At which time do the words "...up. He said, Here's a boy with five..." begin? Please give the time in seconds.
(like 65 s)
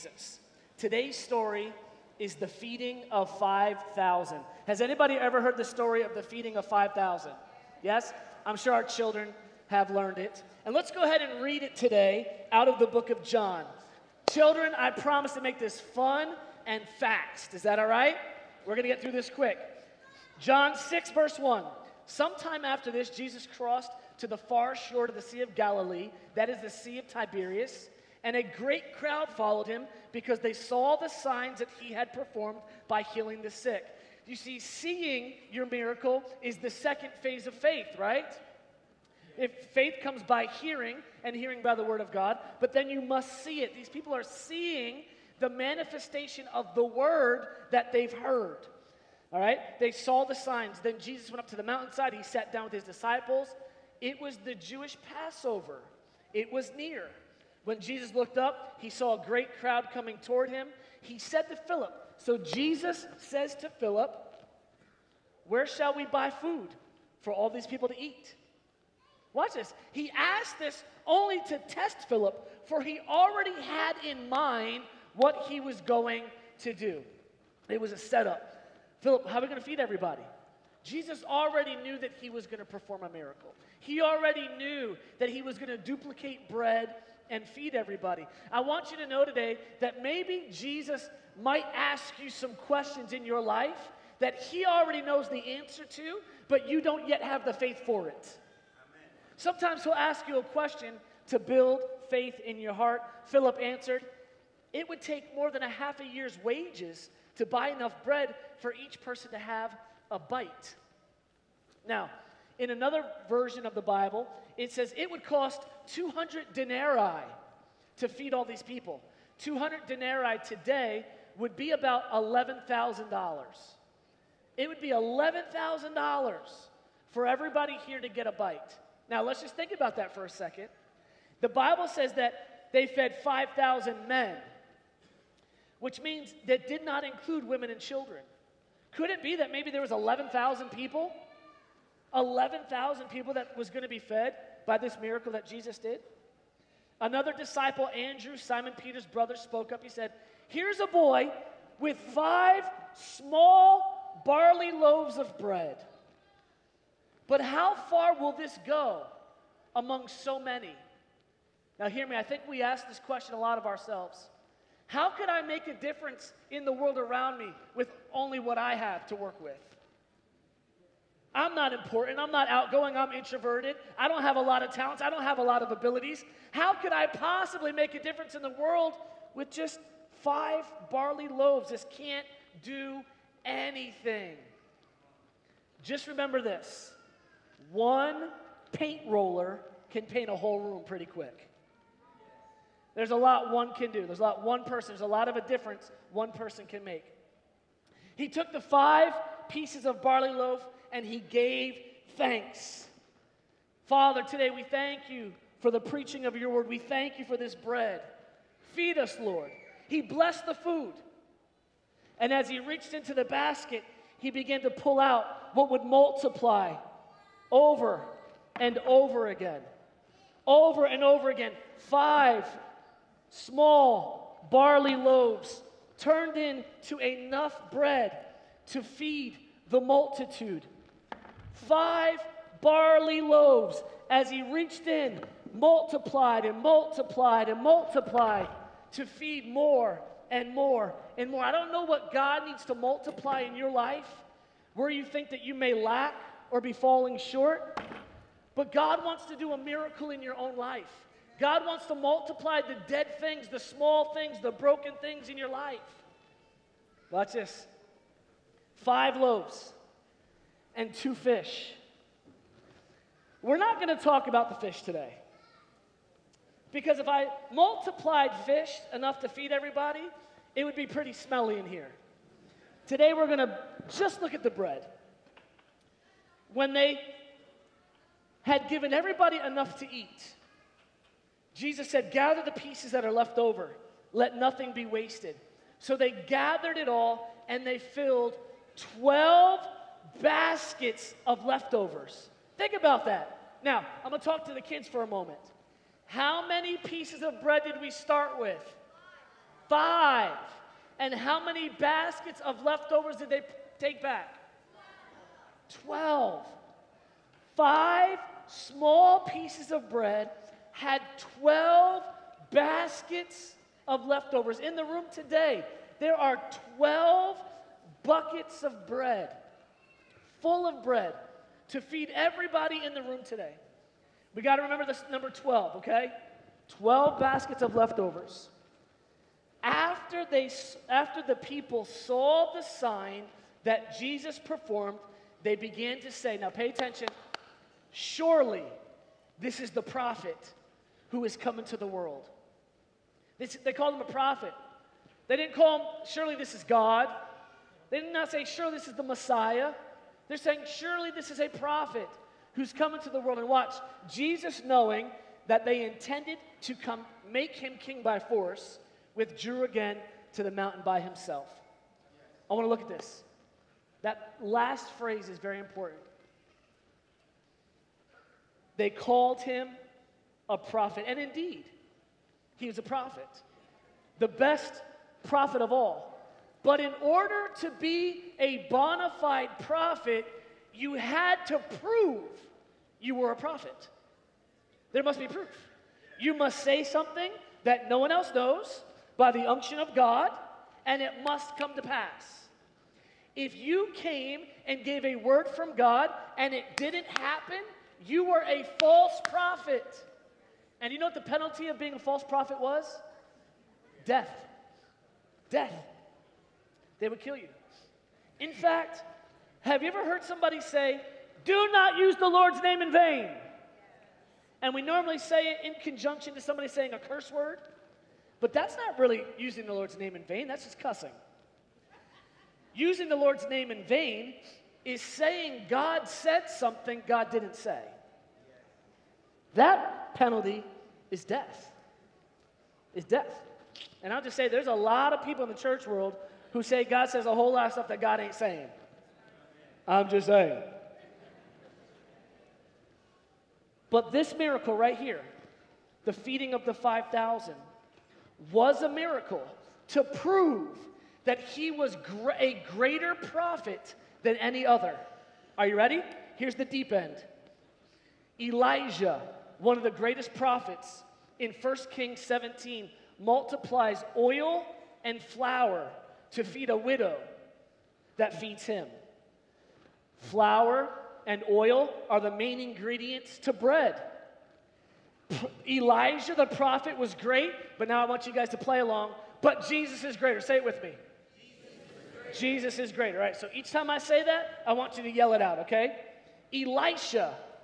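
149 s.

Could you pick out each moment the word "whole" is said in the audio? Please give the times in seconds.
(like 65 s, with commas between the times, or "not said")
190 s, 437 s.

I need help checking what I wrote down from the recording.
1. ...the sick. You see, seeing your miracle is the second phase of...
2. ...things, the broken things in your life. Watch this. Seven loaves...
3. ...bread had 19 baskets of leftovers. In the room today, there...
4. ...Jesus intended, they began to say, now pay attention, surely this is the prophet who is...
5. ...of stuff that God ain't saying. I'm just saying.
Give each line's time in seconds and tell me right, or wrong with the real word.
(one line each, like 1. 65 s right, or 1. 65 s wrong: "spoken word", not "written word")
1. 33 s right
2. 254 s wrong: "Five", not "Seven"
3. 309 s wrong: "12", not "19"
4. 333 s wrong: "performed", not "intended"
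5. 437 s right.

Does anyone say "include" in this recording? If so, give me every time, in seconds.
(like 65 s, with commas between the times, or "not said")
137 s.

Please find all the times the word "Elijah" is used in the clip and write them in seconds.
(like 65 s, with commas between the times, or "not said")
458 s, 475 s.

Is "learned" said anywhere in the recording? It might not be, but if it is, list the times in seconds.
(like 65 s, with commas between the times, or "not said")
9 s.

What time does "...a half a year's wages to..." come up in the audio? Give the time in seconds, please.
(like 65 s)
105 s.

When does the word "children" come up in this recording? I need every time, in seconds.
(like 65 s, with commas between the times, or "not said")
8 s, 14 s, 137 s.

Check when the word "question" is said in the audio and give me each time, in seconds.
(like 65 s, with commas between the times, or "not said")
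92 s, 100 s, 162 s.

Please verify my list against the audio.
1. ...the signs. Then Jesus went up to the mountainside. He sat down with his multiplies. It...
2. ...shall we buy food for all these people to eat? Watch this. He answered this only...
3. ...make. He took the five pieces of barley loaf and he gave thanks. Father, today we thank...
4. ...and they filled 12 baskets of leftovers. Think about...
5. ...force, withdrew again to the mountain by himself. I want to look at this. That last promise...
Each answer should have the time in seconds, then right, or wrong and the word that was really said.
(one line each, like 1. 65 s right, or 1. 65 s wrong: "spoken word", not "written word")
1. 50 s wrong: "disciples", not "multiplies"
2. 65 s wrong: "asked", not "answered"
3. 196 s right
4. 287 s right
5. 358 s wrong: "phrase", not "promise".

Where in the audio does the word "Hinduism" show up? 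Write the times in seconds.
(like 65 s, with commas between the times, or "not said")
not said.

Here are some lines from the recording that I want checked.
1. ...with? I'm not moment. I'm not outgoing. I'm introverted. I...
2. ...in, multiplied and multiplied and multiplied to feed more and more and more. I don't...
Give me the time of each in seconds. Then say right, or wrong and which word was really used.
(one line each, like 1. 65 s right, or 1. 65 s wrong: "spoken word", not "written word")
1. 169 s wrong: "important", not "moment"
2. 234 s right.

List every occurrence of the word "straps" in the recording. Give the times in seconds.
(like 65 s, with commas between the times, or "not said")
not said.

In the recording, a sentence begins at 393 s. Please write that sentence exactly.
If you came and gave a word from God and it didn't happen, you were a false prophet.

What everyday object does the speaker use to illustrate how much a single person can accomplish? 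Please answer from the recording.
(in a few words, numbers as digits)
paint roller.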